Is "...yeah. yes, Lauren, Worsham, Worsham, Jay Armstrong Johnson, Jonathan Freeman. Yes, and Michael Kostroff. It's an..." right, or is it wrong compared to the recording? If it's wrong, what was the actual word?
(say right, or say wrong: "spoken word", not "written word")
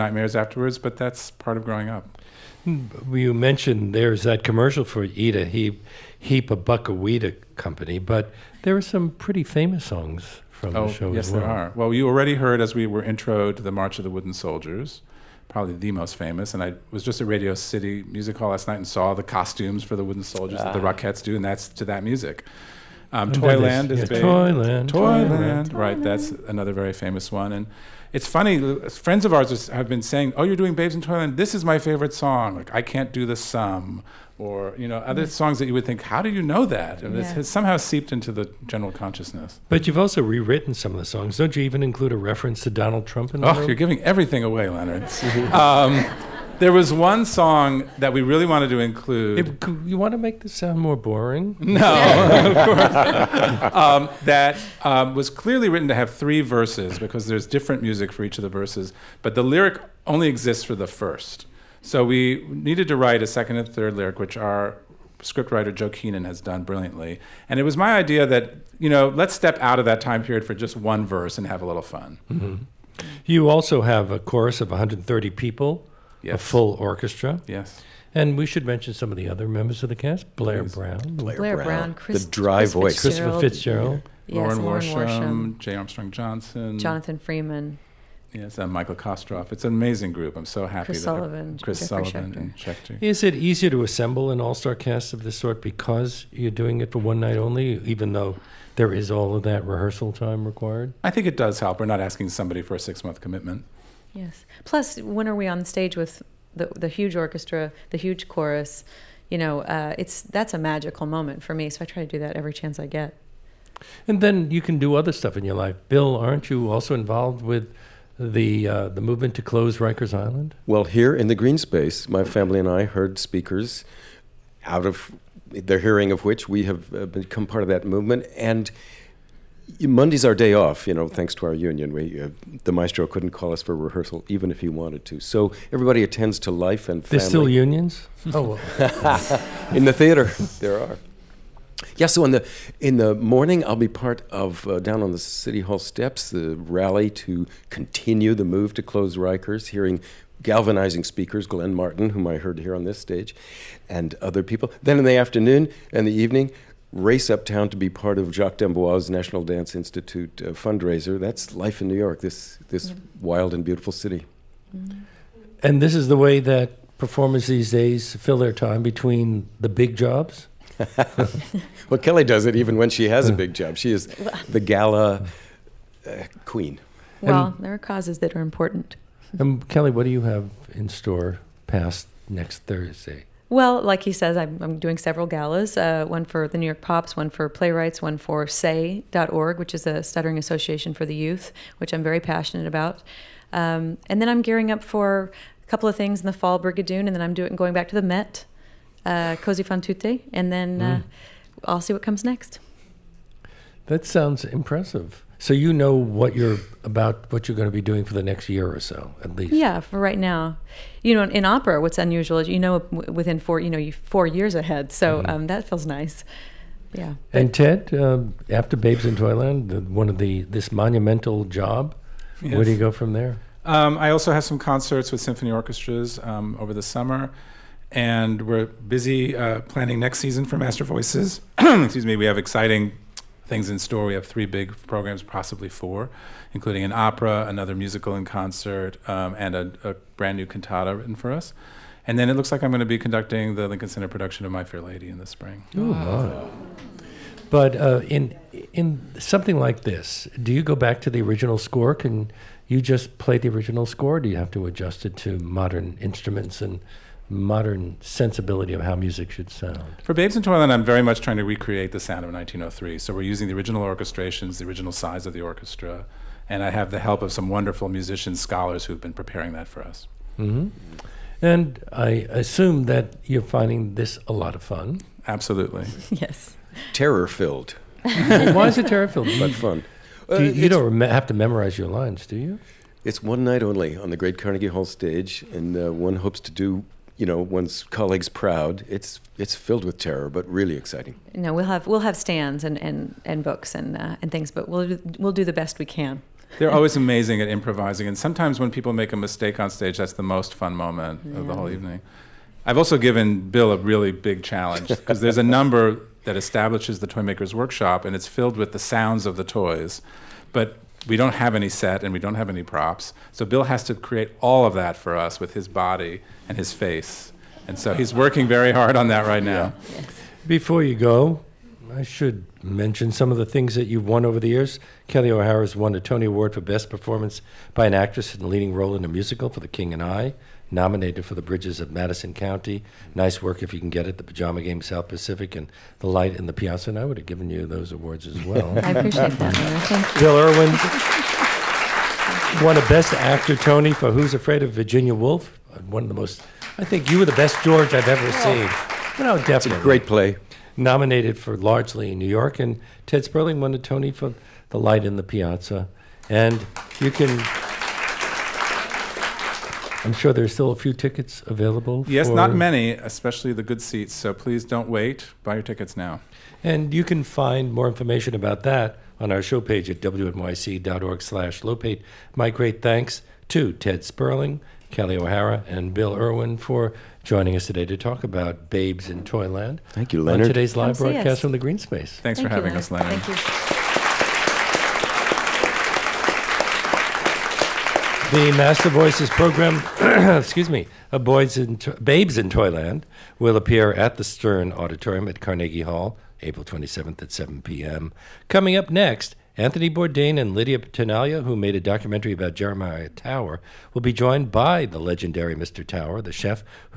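right.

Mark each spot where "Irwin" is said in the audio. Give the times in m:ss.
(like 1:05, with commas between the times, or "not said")
5:40, 6:16.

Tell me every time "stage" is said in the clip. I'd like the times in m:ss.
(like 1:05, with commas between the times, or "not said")
1:45, 2:32, 4:44, 4:59.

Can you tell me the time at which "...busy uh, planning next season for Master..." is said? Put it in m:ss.
3:48.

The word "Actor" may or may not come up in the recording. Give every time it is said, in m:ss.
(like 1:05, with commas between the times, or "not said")
5:43.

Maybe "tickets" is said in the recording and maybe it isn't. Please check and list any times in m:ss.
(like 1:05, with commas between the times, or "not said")
6:00, 6:05.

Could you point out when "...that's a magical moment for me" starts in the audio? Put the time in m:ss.
1:50.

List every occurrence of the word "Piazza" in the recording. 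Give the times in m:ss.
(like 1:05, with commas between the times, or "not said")
5:36, 5:55.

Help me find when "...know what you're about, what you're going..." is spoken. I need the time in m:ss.
3:25.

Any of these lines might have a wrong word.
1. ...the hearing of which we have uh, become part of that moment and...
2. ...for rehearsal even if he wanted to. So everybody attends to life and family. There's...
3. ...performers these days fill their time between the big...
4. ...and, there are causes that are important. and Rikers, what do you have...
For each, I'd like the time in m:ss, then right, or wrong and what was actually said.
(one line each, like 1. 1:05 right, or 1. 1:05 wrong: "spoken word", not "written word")
1. 2:05 wrong: "movement", not "moment"
2. 2:13 right
3. 2:46 right
4. 2:57 wrong: "Kelli", not "Rikers".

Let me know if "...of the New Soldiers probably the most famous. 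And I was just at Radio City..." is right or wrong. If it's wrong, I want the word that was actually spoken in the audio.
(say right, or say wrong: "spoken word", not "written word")
wrong: "Wooden", not "New".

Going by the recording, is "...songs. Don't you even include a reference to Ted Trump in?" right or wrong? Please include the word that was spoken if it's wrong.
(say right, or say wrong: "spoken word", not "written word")
wrong: "Donald", not "Ted".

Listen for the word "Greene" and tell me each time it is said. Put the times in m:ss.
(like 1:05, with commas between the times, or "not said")
2:01, 6:21.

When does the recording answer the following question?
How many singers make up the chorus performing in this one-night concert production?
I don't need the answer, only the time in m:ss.
1:14.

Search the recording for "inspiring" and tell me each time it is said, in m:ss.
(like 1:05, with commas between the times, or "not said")
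not said.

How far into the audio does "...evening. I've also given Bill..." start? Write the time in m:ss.
5:01.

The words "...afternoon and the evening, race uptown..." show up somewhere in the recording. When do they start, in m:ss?
2:35.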